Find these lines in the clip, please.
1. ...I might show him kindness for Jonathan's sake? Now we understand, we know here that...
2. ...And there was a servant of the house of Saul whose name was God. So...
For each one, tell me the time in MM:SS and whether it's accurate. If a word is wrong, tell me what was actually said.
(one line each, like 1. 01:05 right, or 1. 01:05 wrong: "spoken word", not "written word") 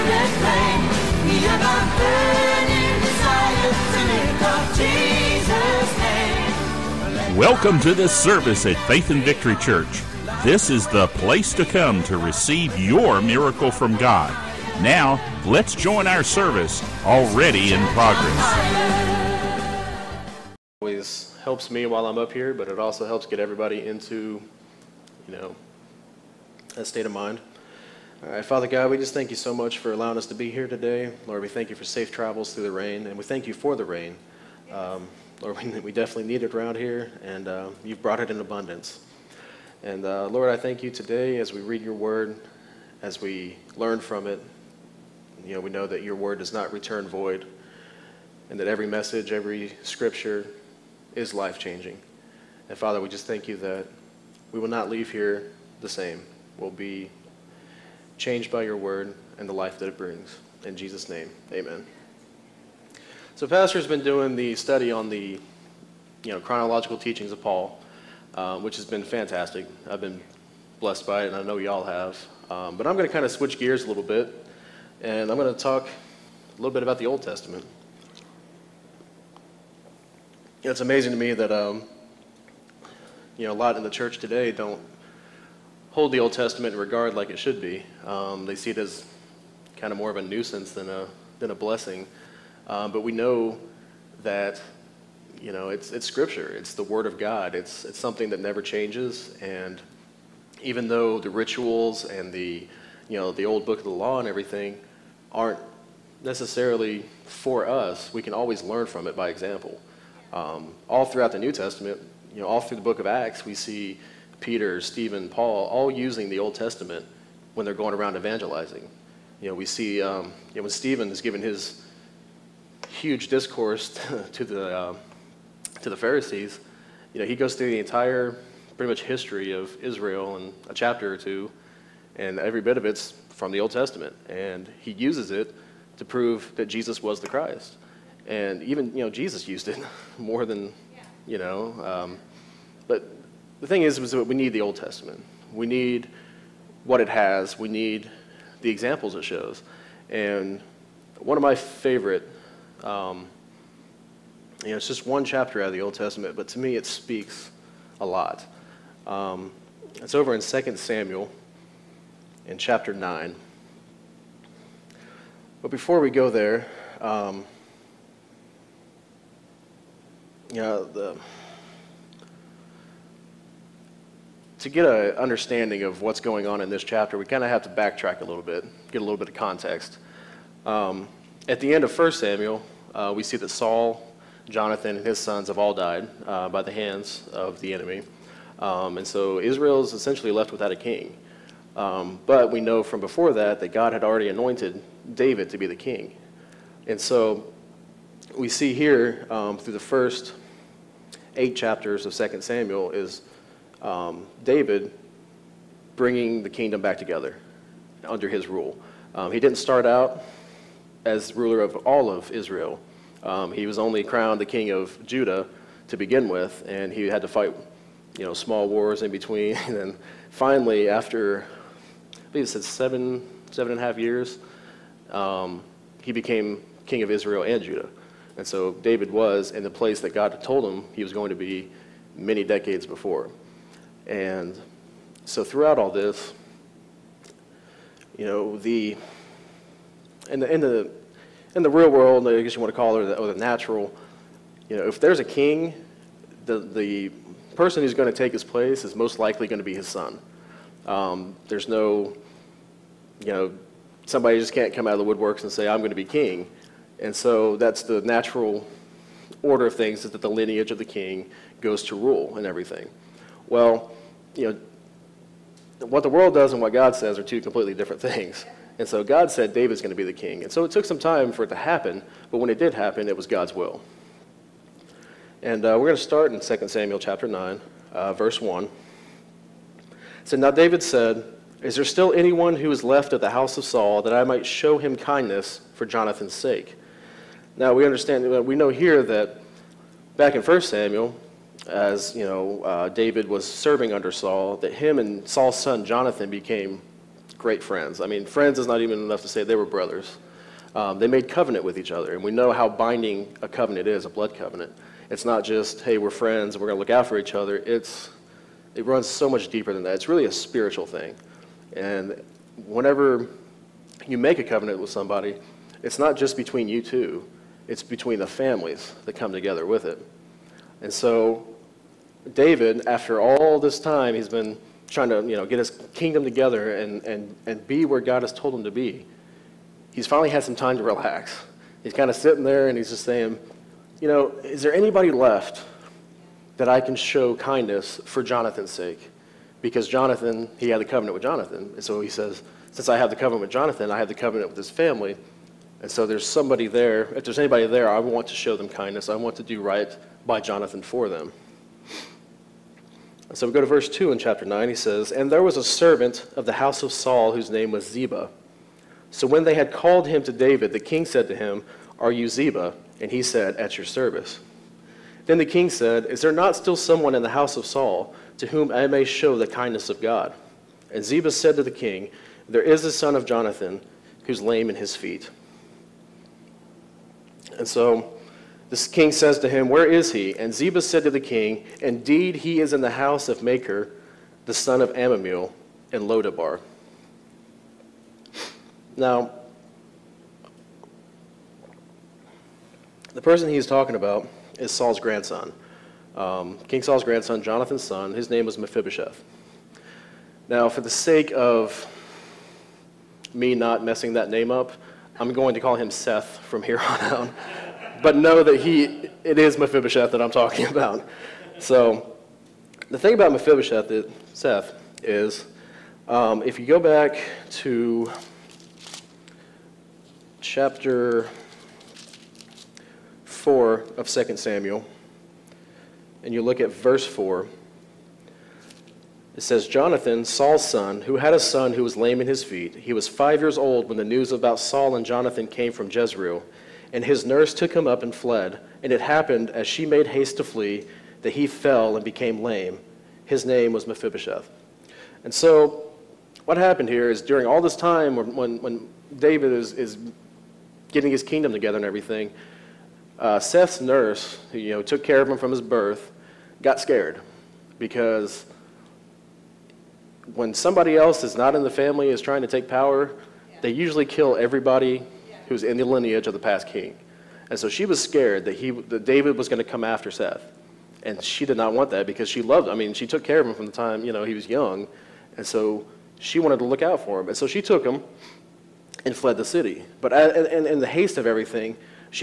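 1. 04:44 right
2. 05:55 wrong: "Ziba", not "God".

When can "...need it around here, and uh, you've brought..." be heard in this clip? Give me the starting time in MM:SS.
00:36.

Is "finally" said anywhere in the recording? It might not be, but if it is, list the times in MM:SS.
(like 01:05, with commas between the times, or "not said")
03:40, 05:30.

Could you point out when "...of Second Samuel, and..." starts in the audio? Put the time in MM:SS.
07:03.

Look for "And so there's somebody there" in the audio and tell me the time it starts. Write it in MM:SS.
05:45.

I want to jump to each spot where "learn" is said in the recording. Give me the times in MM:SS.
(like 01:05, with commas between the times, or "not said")
00:43, 01:48.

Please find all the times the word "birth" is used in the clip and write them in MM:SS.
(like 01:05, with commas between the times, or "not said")
07:35.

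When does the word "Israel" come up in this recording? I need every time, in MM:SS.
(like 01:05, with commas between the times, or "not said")
02:09, 03:09, 03:32, 03:47.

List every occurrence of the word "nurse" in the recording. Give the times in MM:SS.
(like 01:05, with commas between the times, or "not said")
07:17, 07:33.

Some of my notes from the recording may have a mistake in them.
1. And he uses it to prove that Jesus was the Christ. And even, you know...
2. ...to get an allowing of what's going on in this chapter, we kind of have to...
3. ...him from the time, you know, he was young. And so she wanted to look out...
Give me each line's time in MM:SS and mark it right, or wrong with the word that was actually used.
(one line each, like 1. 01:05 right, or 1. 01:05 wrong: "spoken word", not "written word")
1. 02:14 right
2. 02:54 wrong: "understanding", not "allowing"
3. 07:53 right.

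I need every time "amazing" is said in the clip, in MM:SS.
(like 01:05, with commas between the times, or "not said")
01:20.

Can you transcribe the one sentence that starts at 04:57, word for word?
I mean, friends is not even enough to say they were brothers.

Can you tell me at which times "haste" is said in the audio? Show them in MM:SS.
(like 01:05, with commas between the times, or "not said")
07:20, 08:00.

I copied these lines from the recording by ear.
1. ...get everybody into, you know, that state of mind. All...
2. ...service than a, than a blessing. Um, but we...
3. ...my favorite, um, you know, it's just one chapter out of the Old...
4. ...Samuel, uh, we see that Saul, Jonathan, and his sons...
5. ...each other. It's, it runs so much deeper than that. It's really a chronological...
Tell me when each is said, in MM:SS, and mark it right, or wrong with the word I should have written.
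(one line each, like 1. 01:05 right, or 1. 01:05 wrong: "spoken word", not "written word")
1. 00:23 right
2. 01:30 wrong: "nuisance", not "service"
3. 02:31 right
4. 03:02 right
5. 05:07 wrong: "spiritual", not "chronological".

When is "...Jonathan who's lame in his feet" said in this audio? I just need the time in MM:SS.
06:13.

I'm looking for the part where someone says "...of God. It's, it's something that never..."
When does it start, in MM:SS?
01:37.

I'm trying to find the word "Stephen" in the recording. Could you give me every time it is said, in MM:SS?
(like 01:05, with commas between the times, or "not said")
01:54, 02:00.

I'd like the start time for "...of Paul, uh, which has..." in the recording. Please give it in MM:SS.
01:07.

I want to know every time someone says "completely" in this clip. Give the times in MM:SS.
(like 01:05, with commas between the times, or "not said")
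04:27.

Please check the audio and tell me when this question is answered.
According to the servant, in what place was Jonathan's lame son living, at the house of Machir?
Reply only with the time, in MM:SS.
06:26.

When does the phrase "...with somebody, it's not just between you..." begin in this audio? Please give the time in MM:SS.
05:14.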